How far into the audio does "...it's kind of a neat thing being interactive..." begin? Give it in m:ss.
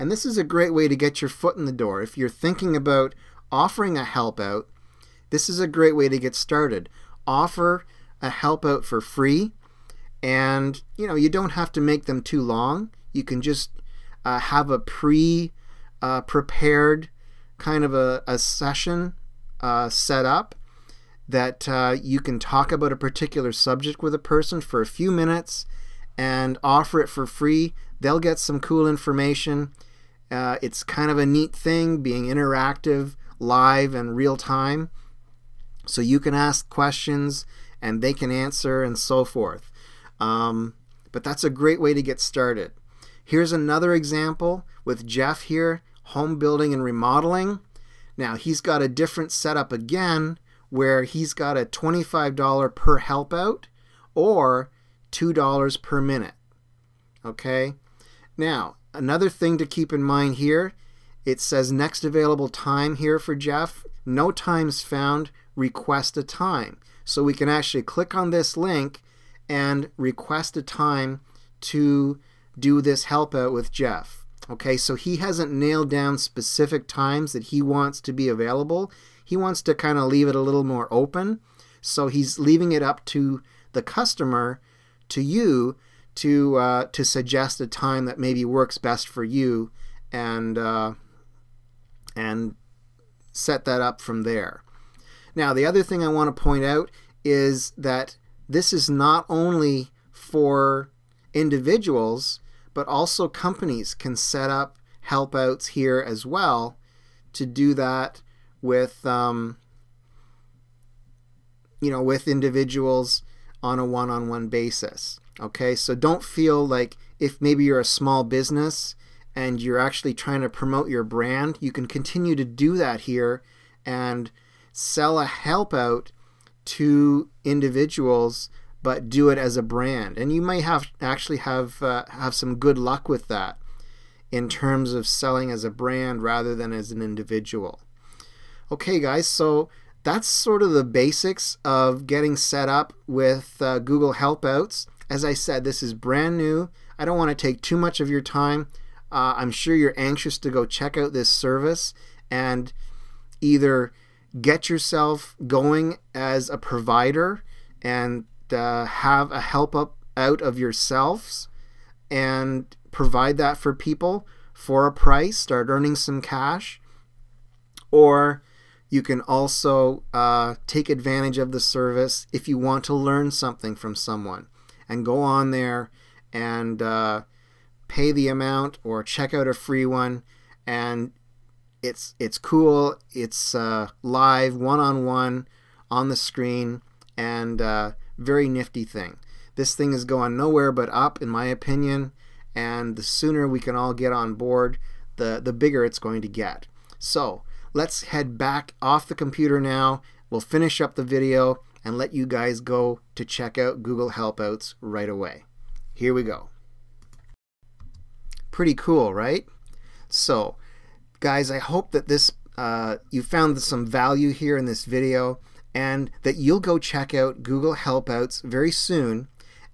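0:30.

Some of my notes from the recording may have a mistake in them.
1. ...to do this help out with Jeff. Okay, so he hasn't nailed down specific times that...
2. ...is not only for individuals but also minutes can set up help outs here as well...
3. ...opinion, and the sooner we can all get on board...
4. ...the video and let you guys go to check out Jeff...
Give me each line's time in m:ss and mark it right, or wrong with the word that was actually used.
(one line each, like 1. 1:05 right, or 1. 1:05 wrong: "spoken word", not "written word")
1. 1:11 right
2. 1:38 wrong: "companies", not "minutes"
3. 3:11 right
4. 3:20 wrong: "Google", not "Jeff".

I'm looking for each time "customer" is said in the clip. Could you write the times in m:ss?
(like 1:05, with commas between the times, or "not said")
1:23.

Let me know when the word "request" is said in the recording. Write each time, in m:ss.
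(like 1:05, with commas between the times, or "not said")
1:05, 1:09.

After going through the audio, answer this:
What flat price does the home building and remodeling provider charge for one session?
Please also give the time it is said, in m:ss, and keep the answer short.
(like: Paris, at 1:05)
$25, at 0:51.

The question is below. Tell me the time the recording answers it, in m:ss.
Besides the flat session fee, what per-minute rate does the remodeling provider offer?
0:55.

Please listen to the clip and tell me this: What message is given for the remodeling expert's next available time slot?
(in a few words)
No times found.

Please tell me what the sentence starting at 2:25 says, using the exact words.
As I said, this is brand new.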